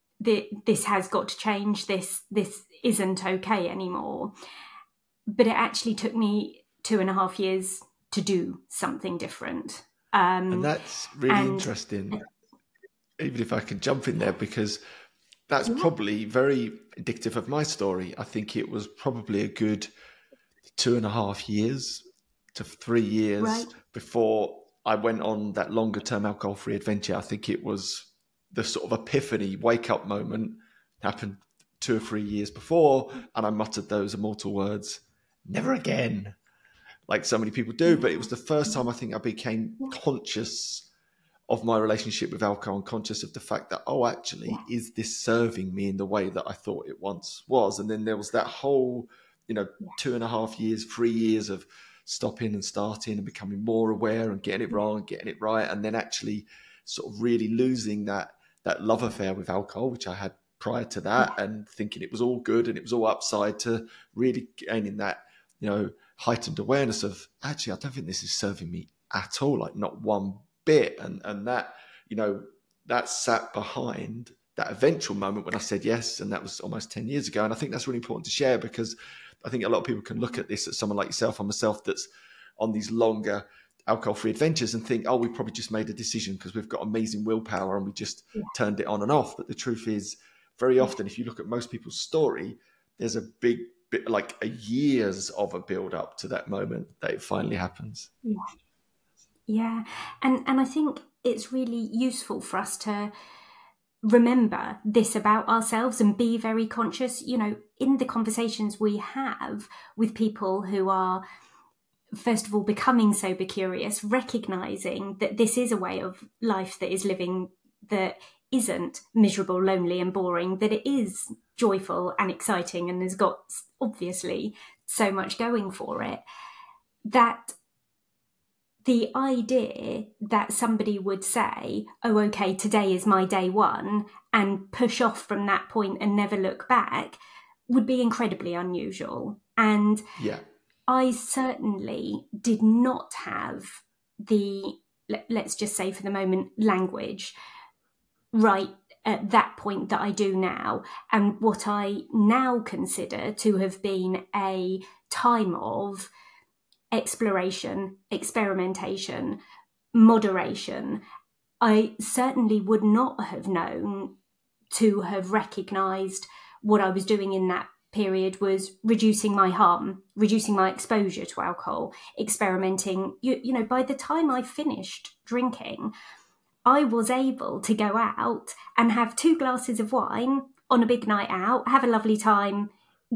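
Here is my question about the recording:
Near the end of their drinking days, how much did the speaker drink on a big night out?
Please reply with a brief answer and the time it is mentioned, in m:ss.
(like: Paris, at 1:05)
2 glasses of wine, at 2:59.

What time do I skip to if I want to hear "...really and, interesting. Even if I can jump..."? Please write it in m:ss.
0:11.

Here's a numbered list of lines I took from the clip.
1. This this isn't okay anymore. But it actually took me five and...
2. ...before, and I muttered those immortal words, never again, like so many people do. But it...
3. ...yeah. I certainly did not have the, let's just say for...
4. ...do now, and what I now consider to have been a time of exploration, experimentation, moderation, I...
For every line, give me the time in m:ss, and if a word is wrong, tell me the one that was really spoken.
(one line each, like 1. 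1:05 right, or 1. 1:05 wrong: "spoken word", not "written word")
1. 0:01 wrong: "two", not "five"
2. 0:32 right
3. 2:20 right
4. 2:30 right.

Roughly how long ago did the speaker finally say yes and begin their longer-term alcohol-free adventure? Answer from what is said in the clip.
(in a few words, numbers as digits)
almost 10 years ago.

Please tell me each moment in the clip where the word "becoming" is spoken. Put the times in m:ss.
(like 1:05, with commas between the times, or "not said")
0:53, 1:52.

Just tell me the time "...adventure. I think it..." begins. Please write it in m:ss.
0:26.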